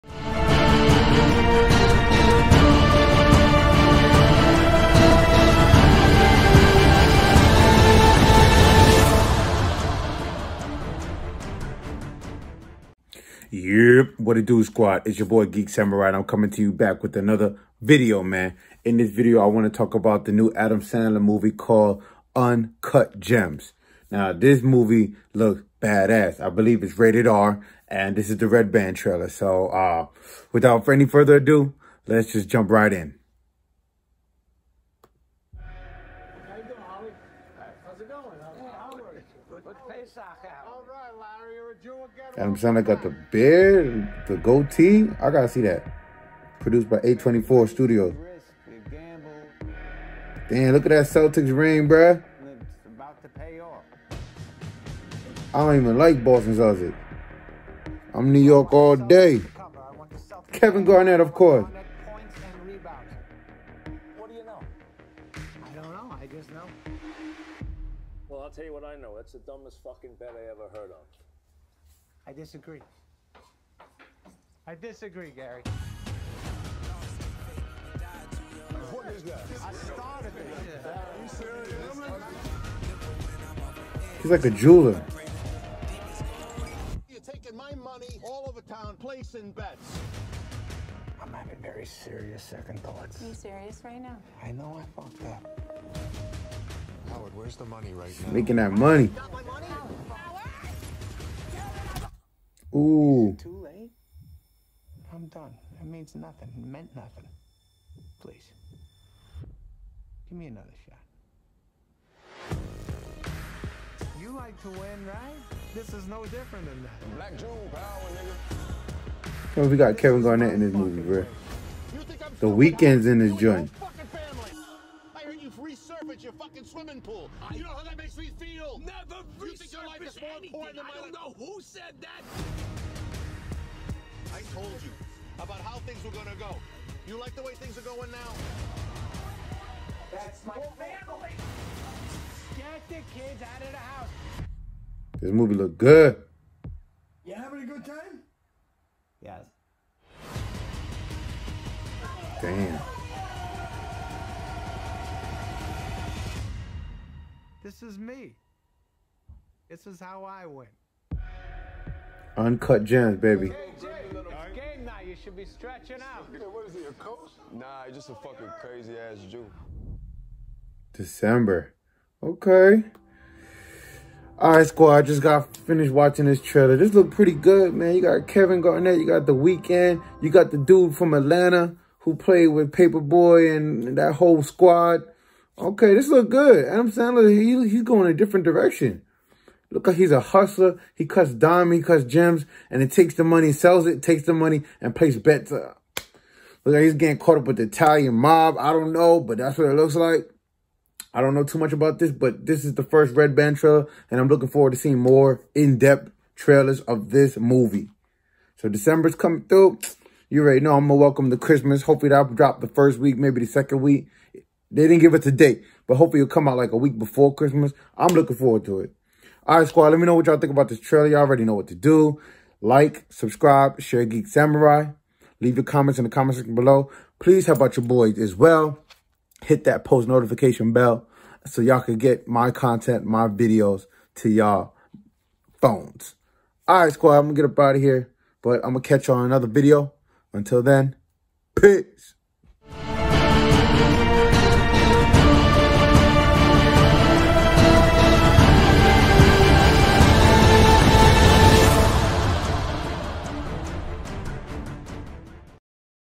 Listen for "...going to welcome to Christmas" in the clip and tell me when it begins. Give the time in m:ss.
3:30.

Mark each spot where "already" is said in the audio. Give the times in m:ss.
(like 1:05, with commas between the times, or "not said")
3:30, 3:41.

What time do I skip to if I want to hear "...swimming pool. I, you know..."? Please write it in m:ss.
2:06.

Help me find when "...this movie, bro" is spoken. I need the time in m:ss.
2:00.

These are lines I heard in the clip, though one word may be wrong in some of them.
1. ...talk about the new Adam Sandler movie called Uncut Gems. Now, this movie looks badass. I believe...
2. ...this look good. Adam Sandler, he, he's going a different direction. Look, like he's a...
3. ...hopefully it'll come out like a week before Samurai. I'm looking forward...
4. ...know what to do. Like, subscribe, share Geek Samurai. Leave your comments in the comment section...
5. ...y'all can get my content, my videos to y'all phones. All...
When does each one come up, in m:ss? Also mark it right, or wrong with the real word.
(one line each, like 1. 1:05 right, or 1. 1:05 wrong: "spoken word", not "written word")
1. 0:19 right
2. 3:05 right
3. 3:35 wrong: "Christmas", not "Samurai"
4. 3:41 right
5. 3:51 right.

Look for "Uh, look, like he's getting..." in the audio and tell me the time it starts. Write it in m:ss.
3:15.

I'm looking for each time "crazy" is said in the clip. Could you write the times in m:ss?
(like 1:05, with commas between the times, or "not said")
2:48.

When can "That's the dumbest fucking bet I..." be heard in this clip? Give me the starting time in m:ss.
1:09.